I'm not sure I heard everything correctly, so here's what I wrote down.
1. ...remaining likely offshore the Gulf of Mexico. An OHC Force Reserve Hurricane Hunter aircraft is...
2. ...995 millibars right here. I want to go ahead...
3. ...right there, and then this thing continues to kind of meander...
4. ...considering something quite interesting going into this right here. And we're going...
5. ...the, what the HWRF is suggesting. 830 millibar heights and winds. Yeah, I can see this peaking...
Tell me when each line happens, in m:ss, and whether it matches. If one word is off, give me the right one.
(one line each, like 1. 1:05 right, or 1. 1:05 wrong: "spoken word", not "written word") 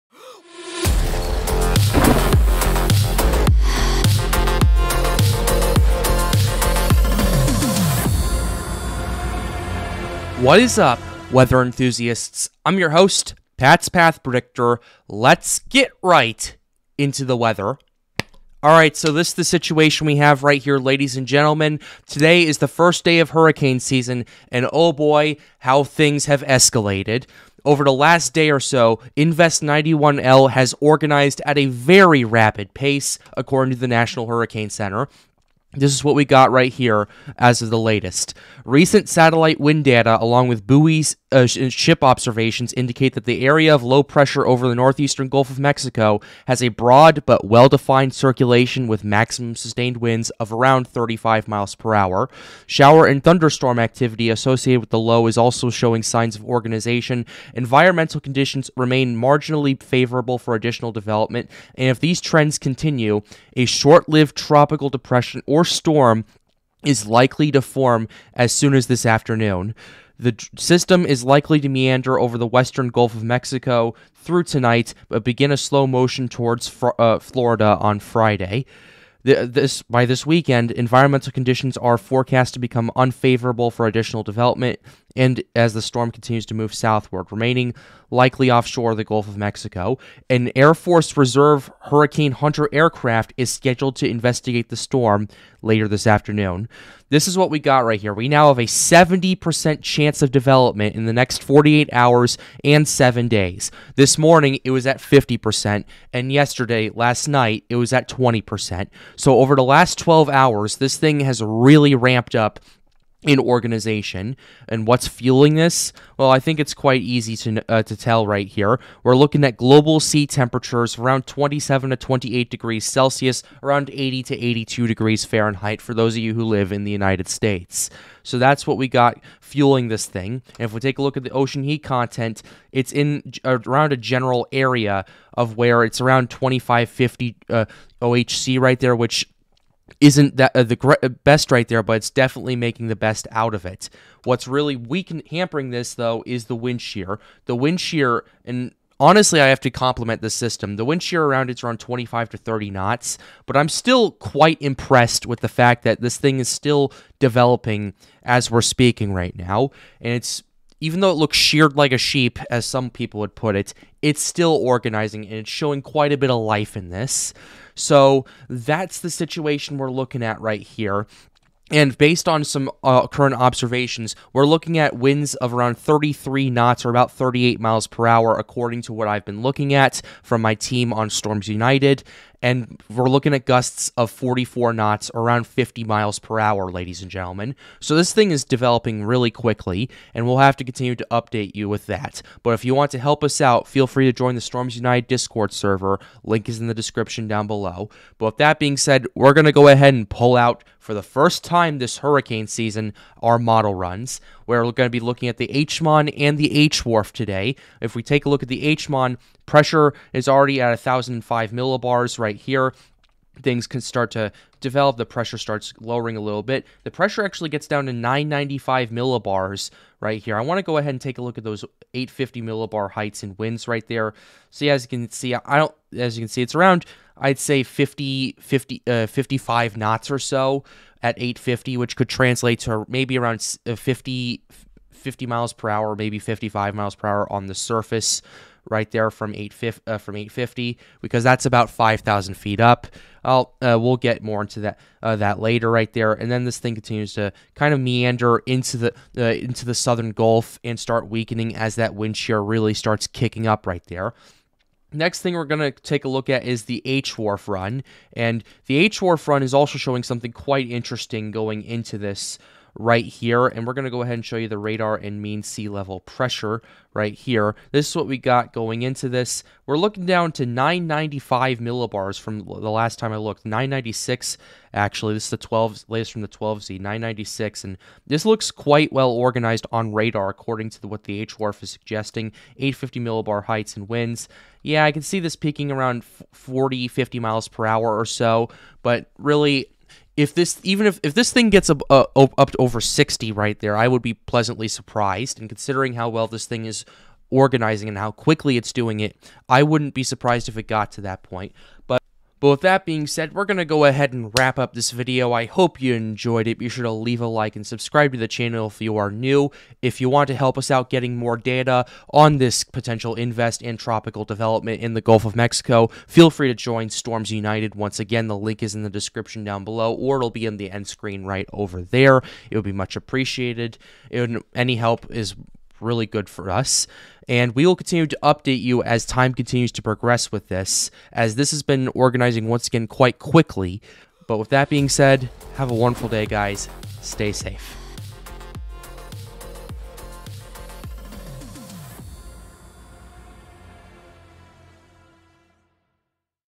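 1. 1:27 wrong: "Air", not "OHC"
2. 3:37 right
3. 4:05 right
4. 4:19 wrong: "showing", not "considering"
5. 4:40 wrong: "850", not "830".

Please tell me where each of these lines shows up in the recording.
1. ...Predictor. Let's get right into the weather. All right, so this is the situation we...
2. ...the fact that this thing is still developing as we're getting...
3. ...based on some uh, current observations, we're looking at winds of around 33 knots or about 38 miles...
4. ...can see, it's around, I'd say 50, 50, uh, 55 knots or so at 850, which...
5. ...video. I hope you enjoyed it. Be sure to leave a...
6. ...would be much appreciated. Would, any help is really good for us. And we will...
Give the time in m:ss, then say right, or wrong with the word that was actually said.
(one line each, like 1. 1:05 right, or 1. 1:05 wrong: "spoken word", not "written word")
1. 0:14 right
2. 2:35 wrong: "speaking", not "getting"
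3. 2:51 right
4. 3:46 right
5. 5:04 right
6. 5:22 right.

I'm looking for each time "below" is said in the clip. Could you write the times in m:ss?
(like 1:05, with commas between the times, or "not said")
3:17, 5:19.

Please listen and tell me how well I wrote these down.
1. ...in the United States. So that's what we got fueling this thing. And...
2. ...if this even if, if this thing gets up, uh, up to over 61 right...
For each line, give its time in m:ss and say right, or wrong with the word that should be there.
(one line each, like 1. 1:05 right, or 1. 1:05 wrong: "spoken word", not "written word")
1. 2:06 right
2. 4:50 wrong: "60", not "61".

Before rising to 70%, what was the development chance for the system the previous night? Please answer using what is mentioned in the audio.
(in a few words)
20%.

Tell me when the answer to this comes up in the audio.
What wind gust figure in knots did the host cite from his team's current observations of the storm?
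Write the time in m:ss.
3:04.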